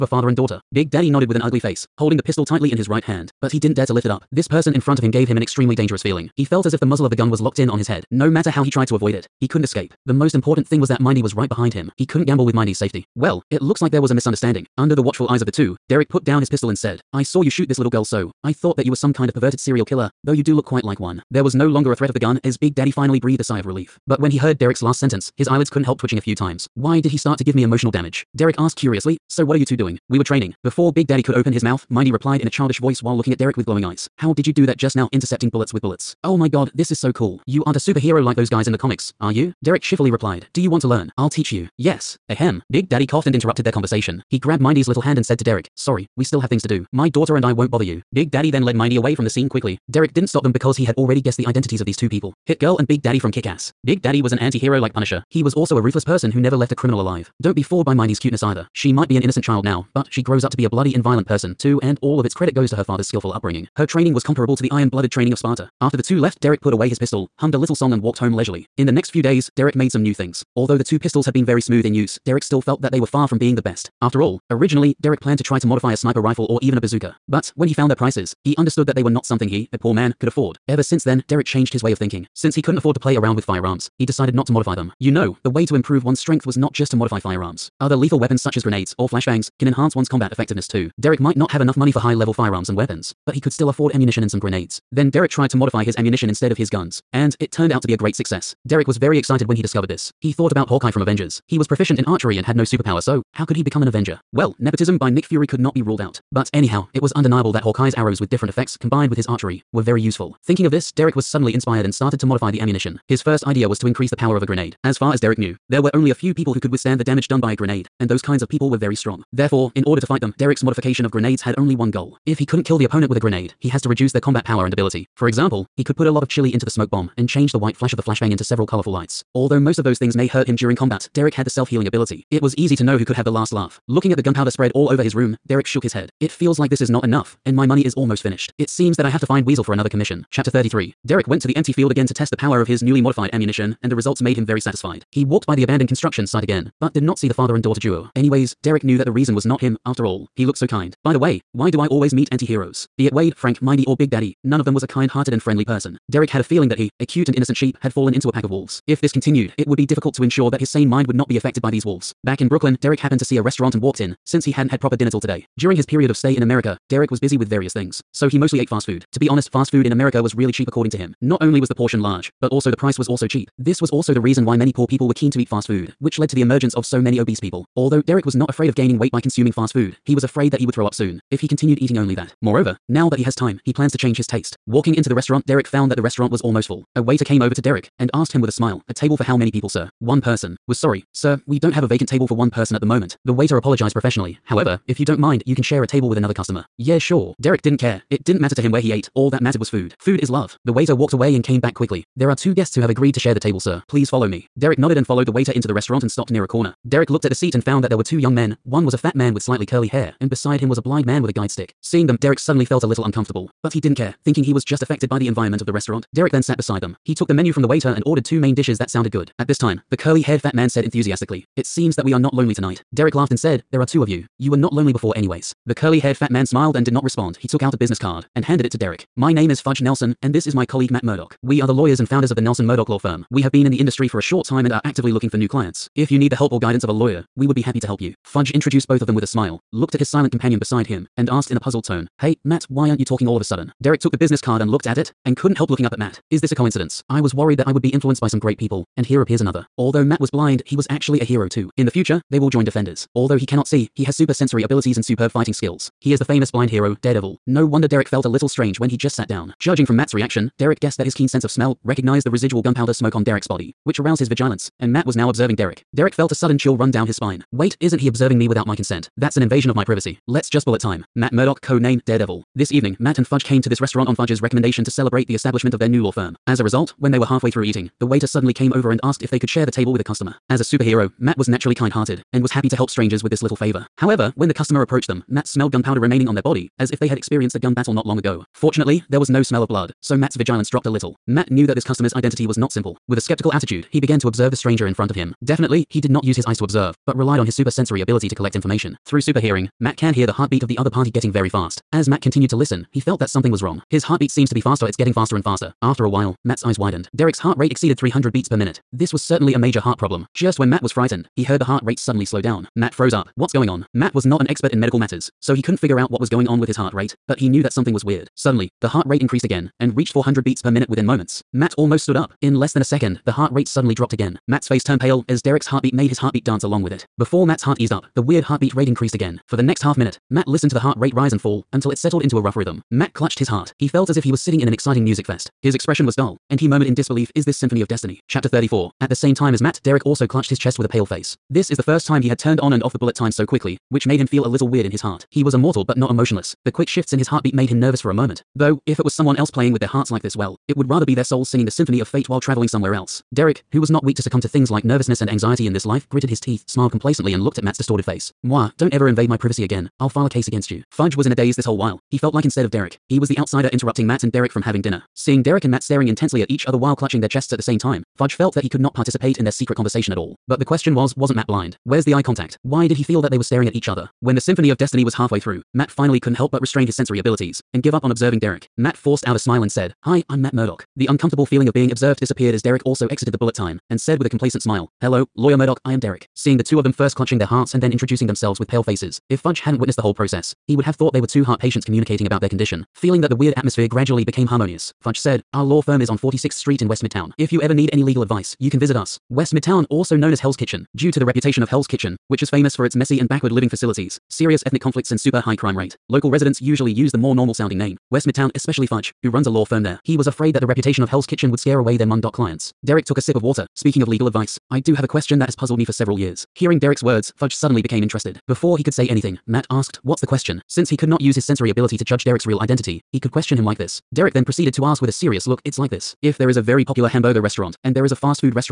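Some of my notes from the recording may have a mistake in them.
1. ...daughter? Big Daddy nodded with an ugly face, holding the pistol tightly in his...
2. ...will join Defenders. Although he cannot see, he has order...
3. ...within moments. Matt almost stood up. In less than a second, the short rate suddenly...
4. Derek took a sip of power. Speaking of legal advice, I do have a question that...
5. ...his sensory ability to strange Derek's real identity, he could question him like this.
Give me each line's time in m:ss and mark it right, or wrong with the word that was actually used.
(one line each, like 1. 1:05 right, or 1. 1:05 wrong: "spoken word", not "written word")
1. 0:00 right
2. 4:12 wrong: "super", not "order"
3. 5:20 wrong: "heart", not "short"
4. 6:52 wrong: "water", not "power"
5. 7:01 wrong: "judge", not "strange".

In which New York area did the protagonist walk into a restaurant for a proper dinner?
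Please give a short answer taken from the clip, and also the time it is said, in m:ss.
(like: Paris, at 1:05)
Brooklyn, at 2:42.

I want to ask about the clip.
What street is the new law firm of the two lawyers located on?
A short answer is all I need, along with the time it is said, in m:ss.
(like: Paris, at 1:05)
46th Street, at 6:36.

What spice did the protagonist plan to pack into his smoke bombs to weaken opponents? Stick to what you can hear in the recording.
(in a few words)
chili.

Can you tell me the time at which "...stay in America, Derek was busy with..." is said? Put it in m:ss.
2:46.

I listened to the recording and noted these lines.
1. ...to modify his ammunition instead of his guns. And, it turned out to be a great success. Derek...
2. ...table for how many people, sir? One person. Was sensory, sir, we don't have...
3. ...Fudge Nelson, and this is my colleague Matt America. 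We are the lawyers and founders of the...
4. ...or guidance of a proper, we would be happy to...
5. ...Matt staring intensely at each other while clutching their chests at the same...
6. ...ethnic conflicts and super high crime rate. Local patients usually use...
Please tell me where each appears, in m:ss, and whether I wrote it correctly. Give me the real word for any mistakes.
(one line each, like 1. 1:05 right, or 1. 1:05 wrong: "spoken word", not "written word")
1. 1:35 right
2. 3:08 wrong: "sorry", not "sensory"
3. 3:49 wrong: "Murdock", not "America"
4. 3:56 wrong: "lawyer", not "proper"
5. 6:05 right
6. 6:44 wrong: "residents", not "patients".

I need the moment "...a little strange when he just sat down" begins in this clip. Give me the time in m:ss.
4:18.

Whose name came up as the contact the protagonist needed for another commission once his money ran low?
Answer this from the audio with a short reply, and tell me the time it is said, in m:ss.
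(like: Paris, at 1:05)
Weasel, at 2:19.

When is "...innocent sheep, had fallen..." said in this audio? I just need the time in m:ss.
2:37.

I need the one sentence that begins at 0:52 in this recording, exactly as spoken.
Hit Girl and Big Daddy from Kick-Ass.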